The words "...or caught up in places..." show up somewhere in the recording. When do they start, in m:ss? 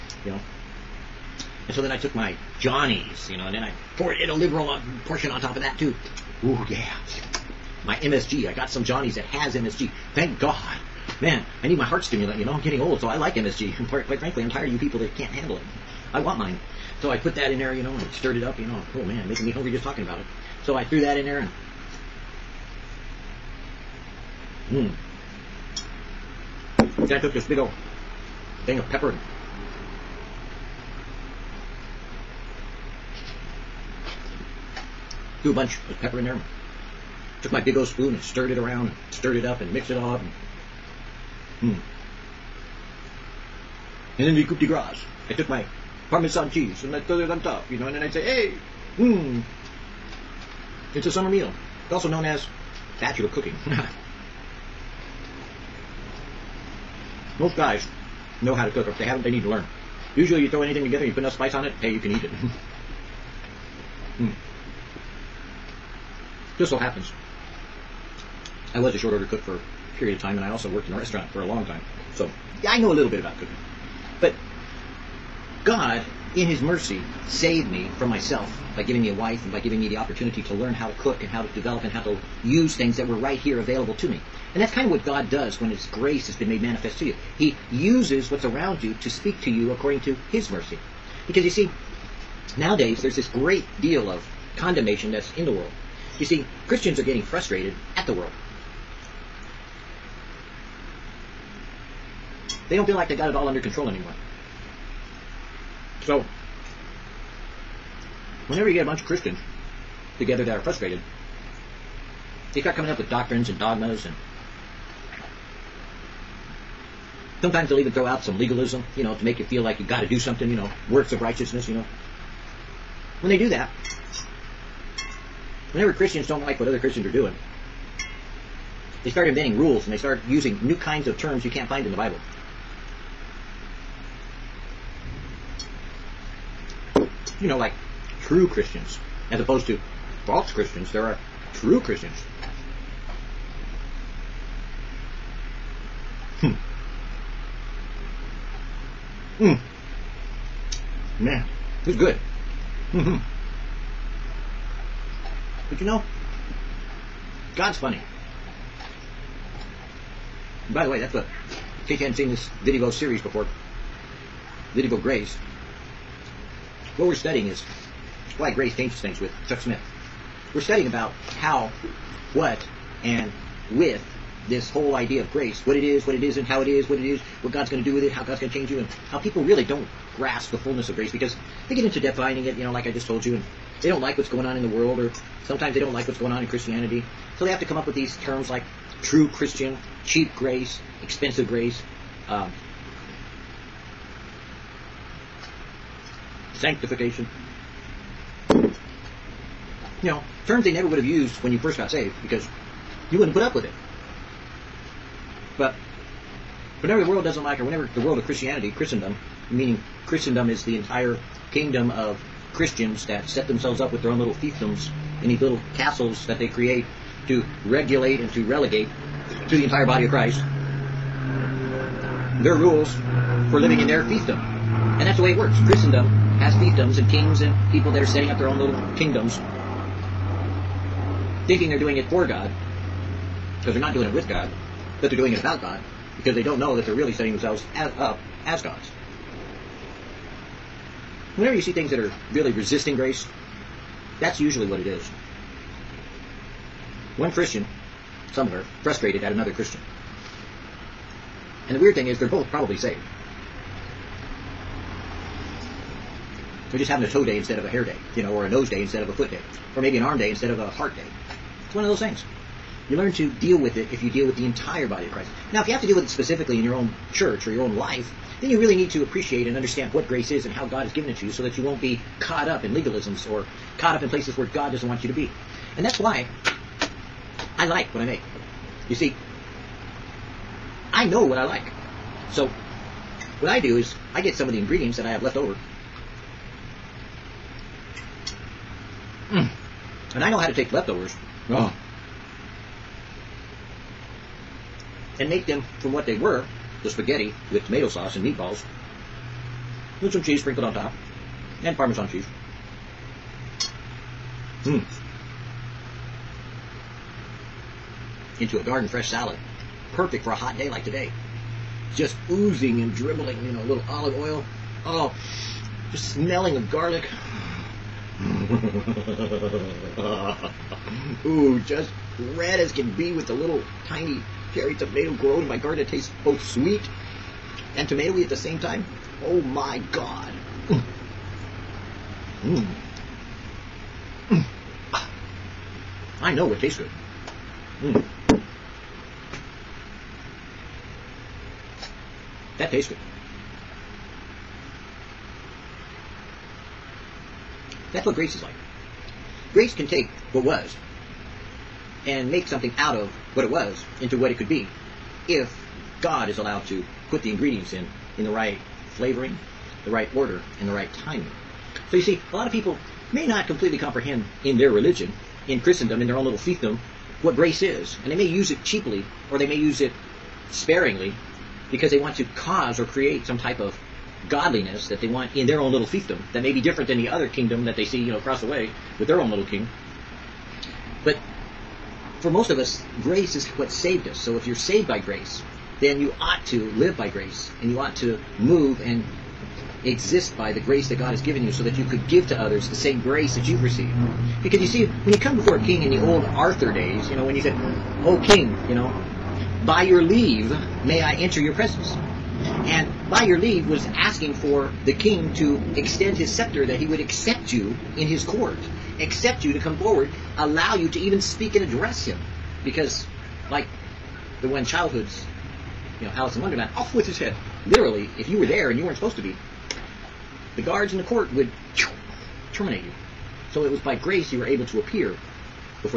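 4:33.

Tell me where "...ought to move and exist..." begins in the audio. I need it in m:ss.
6:27.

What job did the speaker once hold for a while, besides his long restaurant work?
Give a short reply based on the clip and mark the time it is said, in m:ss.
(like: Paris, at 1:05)
Short order cook, at 1:08.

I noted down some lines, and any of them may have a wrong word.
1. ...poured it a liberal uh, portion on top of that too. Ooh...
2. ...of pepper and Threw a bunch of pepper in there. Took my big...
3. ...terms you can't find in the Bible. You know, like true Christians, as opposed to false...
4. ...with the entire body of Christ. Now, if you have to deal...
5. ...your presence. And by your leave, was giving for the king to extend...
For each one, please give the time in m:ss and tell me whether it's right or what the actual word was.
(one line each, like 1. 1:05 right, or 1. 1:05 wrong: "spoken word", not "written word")
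1. 0:03 right
2. 0:28 right
3. 2:11 right
4. 4:24 right
5. 6:41 wrong: "asking", not "giving".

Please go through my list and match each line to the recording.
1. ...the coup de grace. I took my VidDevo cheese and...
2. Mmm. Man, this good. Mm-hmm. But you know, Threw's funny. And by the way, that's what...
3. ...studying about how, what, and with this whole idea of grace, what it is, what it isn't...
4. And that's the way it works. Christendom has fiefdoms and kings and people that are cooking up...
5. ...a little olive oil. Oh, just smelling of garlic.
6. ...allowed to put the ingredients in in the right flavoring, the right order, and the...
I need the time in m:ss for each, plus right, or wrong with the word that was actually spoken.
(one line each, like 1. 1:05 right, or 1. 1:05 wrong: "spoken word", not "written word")
1. 0:44 wrong: "Parmesan", not "VidDevo"
2. 2:29 wrong: "God", not "Threw"
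3. 2:50 right
4. 3:44 wrong: "setting", not "cooking"
5. 5:13 right
6. 5:56 right.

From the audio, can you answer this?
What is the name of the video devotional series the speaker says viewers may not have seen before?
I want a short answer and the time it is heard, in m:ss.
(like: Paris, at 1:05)
VidDevo Grace, at 2:44.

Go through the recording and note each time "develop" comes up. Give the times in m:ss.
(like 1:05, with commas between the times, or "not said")
1:21.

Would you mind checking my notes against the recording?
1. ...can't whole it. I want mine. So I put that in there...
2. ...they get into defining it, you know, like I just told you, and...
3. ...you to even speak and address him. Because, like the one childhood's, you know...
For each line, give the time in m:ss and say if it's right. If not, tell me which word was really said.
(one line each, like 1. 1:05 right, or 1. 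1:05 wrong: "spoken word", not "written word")
1. 0:15 wrong: "handle", not "whole"
2. 3:01 right
3. 6:50 right.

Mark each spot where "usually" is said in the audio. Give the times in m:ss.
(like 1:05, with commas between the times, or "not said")
1:00, 4:04.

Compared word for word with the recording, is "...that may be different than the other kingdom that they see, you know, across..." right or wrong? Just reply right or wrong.
right.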